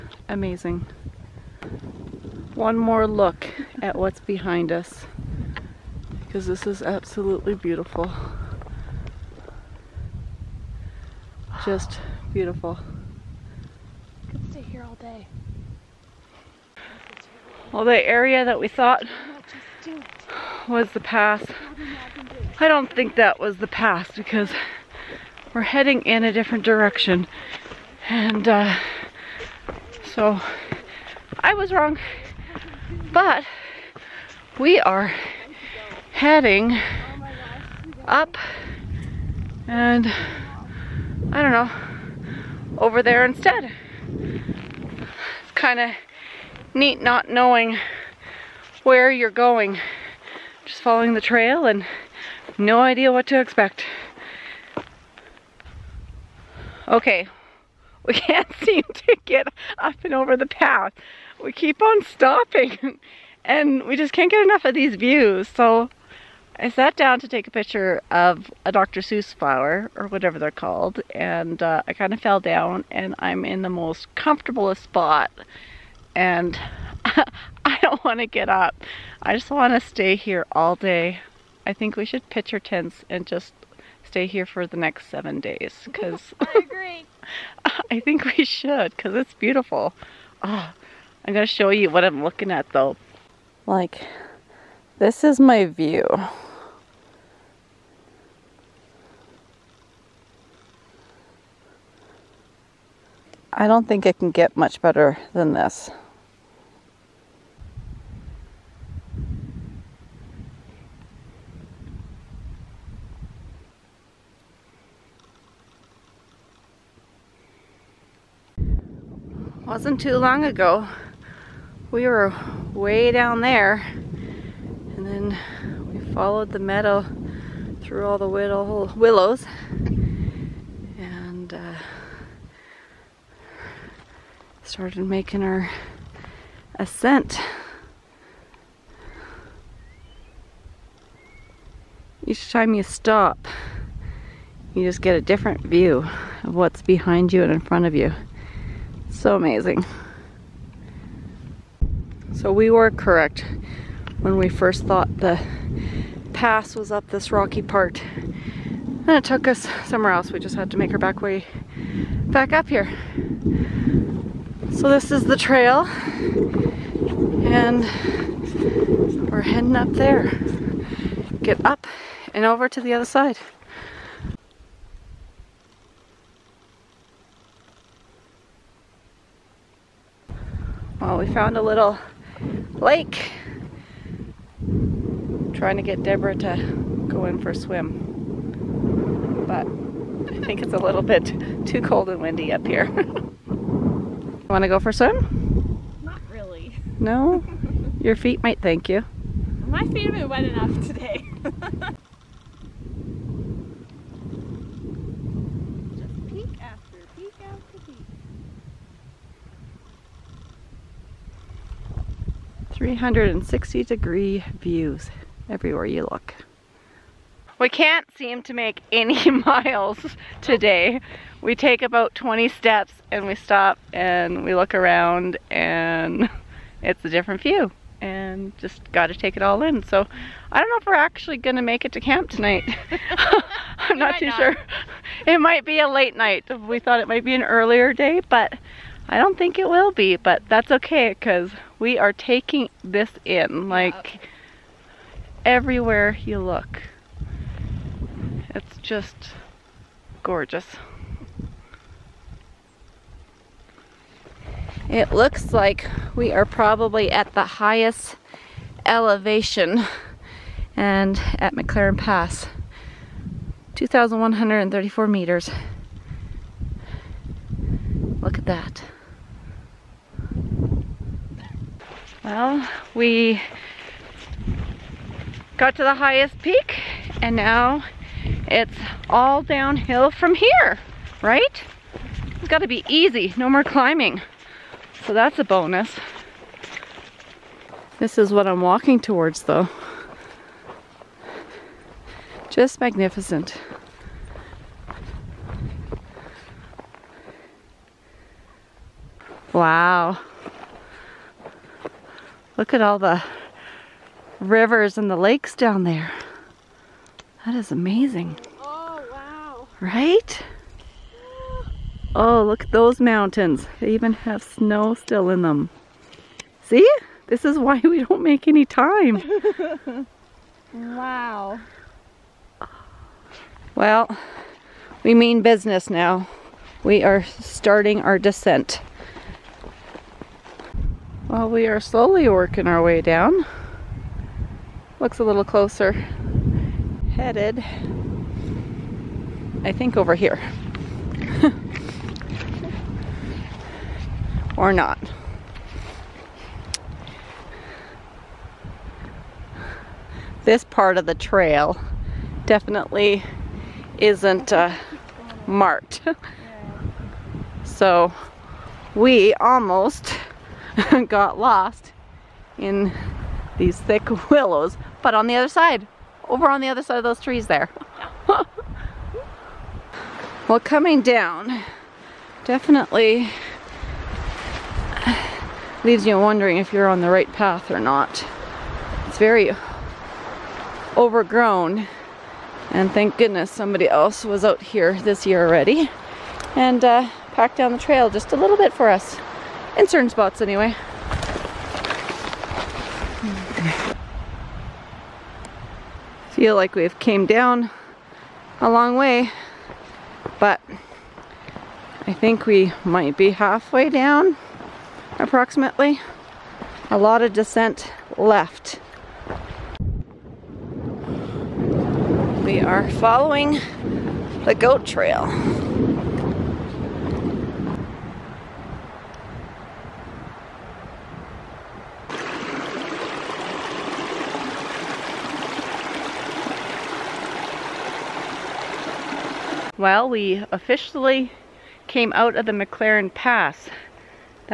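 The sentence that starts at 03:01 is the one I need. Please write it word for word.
Well, we found a little lake.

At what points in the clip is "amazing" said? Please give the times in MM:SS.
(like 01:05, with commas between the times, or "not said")
00:00, 02:29, 05:07.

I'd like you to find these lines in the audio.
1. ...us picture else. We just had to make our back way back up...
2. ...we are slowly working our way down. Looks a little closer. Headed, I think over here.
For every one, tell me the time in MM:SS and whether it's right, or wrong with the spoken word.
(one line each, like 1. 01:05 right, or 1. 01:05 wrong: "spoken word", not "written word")
1. 02:39 wrong: "somewhere", not "picture"
2. 05:31 right.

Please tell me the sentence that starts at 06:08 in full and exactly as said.
well, coming down, definitely leaves you wondering if you're on the right path or not.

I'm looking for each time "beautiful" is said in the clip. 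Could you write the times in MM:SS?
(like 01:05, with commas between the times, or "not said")
00:07, 00:12, 01:29.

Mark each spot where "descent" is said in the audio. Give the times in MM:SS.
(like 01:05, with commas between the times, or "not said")
05:28, 06:47.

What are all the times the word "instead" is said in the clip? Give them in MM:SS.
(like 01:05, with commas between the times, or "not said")
00:43.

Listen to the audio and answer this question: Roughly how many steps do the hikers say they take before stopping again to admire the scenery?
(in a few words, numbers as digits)
20.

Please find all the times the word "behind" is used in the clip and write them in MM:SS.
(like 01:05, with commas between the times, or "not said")
00:04, 02:26.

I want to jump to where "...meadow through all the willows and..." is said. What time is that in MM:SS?
02:06.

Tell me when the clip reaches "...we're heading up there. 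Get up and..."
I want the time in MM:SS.
02:49.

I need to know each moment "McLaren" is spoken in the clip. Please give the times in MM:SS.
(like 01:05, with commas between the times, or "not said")
04:21, 07:12.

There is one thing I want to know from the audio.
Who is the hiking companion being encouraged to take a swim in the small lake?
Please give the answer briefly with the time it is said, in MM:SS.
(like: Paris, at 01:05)
Deborah, at 03:06.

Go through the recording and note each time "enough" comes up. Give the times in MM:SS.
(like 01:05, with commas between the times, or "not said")
01:04, 03:20.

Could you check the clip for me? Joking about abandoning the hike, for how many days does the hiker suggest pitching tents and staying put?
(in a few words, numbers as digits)
7.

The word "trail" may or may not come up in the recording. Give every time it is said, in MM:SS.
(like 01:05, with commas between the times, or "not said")
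00:51, 02:45, 05:51, 06:27, 06:54.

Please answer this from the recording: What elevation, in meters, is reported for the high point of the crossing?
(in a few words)
2,134 meters.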